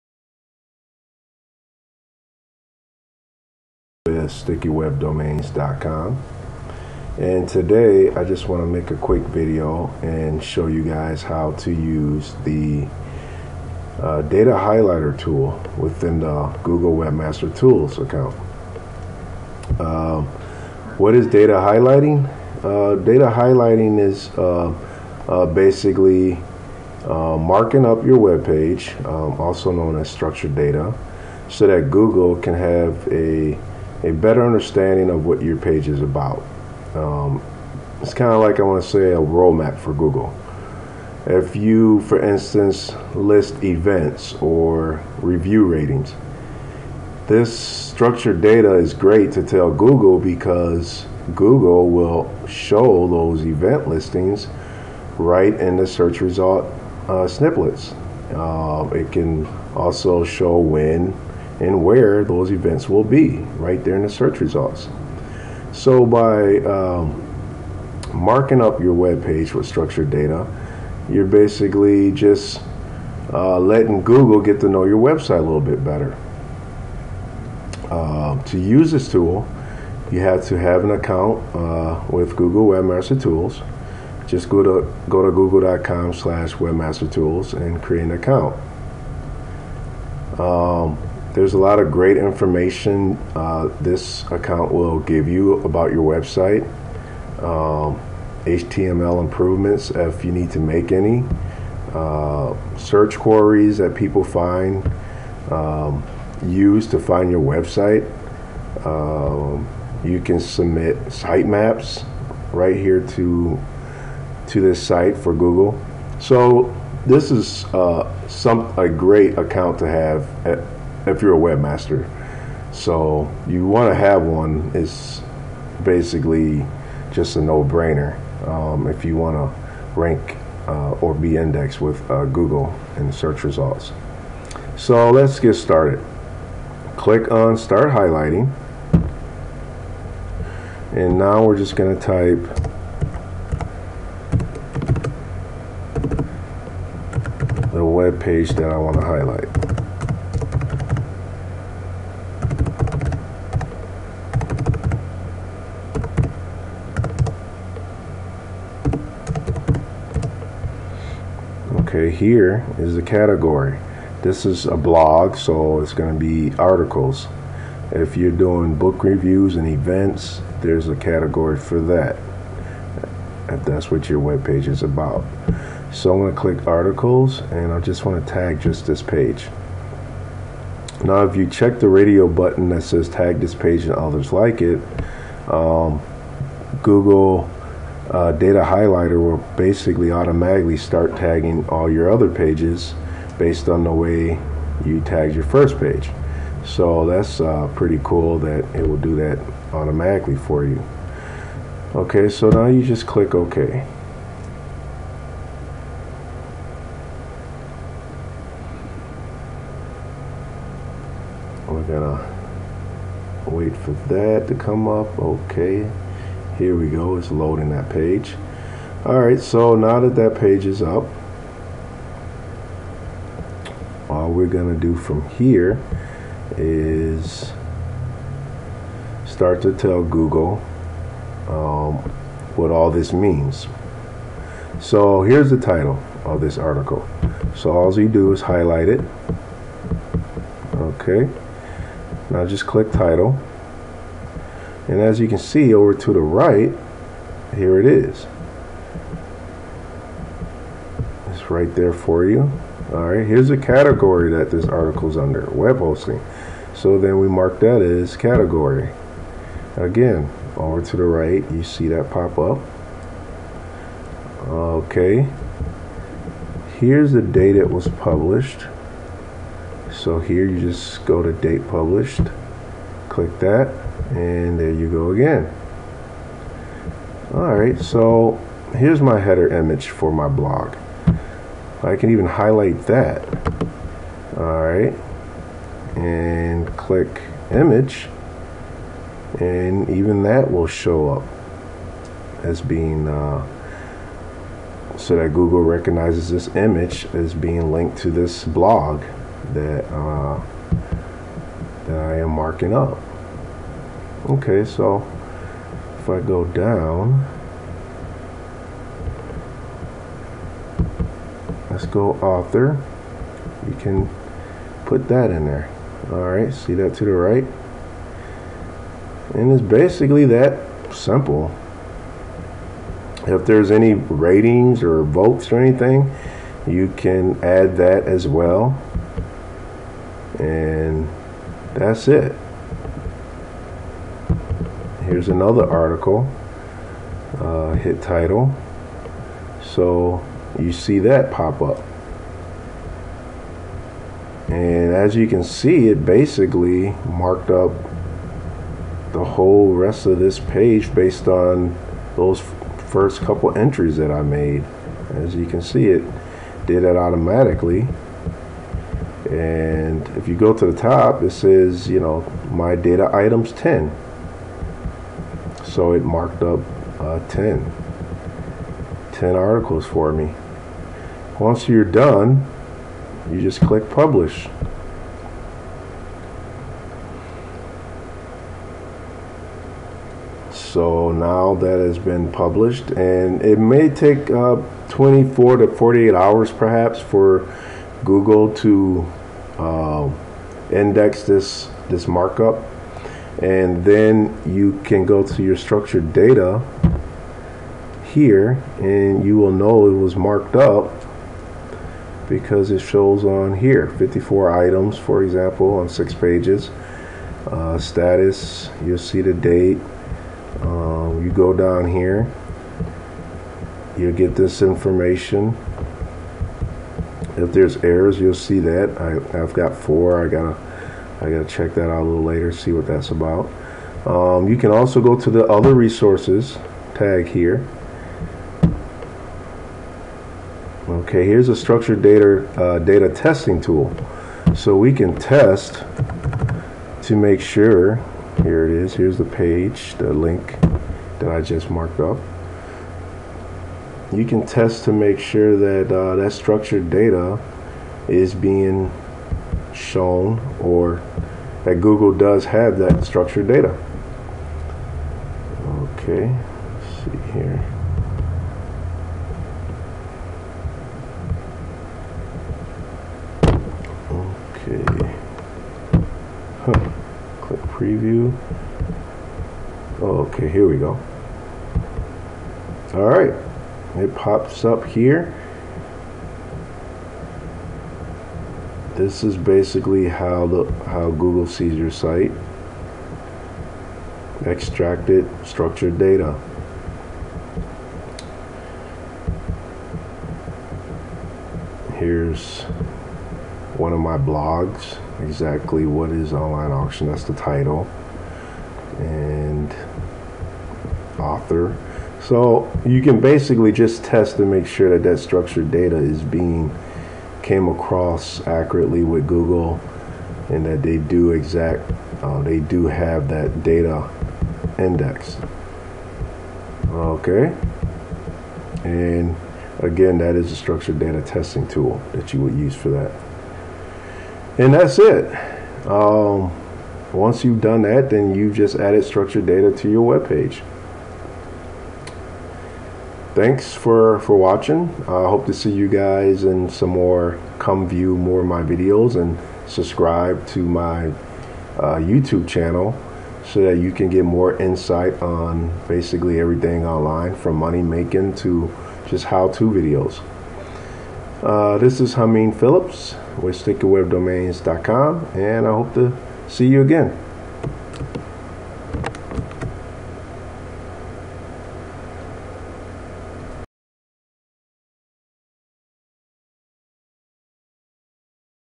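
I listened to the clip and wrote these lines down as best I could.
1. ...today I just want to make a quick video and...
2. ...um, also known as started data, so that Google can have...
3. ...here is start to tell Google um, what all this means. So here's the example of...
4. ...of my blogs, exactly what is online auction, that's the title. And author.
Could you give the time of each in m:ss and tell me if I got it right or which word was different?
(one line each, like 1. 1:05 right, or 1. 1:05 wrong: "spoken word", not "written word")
1. 0:07 right
2. 0:29 wrong: "structured", not "started"
3. 3:45 wrong: "title", not "example"
4. 8:13 right.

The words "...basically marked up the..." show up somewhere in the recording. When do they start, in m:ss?
5:46.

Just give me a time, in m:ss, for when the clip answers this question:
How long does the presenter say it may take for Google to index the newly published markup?
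6:24.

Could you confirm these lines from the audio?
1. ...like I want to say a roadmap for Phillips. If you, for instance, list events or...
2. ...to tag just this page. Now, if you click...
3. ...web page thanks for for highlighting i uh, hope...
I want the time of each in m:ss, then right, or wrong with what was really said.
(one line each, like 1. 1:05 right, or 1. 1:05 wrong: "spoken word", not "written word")
1. 0:38 wrong: "Google", not "Phillips"
2. 2:58 wrong: "check", not "click"
3. 8:50 wrong: "watching", not "highlighting".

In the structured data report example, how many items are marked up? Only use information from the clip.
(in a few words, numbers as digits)
54.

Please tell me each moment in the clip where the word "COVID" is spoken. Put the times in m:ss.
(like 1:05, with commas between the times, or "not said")
not said.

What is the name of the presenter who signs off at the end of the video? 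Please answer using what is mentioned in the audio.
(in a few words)
Hameen Phillips.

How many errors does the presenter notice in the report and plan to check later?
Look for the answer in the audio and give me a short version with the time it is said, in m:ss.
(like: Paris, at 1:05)
4, at 6:59.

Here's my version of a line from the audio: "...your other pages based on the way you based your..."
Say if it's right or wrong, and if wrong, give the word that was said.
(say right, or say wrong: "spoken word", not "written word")
wrong: "tagged", not "based".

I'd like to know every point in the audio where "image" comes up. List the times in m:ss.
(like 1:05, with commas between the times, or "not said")
4:39, 4:47, 4:56.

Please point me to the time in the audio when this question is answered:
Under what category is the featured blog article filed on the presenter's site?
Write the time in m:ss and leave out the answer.
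4:15.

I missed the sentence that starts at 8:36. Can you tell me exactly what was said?
Okay, and again, that is a structured data testing tool that you would use for that.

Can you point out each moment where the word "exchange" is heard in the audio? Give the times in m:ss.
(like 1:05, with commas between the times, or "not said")
not said.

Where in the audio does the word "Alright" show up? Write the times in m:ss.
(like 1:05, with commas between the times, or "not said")
3:39.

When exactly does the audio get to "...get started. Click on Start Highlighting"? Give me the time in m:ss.
2:15.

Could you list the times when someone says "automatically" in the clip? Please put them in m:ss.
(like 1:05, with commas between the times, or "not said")
3:10, 3:19, 5:56.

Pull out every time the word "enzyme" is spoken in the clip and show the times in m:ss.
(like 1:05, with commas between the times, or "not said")
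not said.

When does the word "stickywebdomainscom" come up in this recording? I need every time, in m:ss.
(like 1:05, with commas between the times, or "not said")
0:04, 9:13.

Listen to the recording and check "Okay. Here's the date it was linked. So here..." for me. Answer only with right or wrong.
wrong.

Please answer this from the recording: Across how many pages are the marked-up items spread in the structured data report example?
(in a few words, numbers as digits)
six.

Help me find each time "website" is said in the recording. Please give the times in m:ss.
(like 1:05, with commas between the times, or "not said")
1:14, 1:36, 1:47.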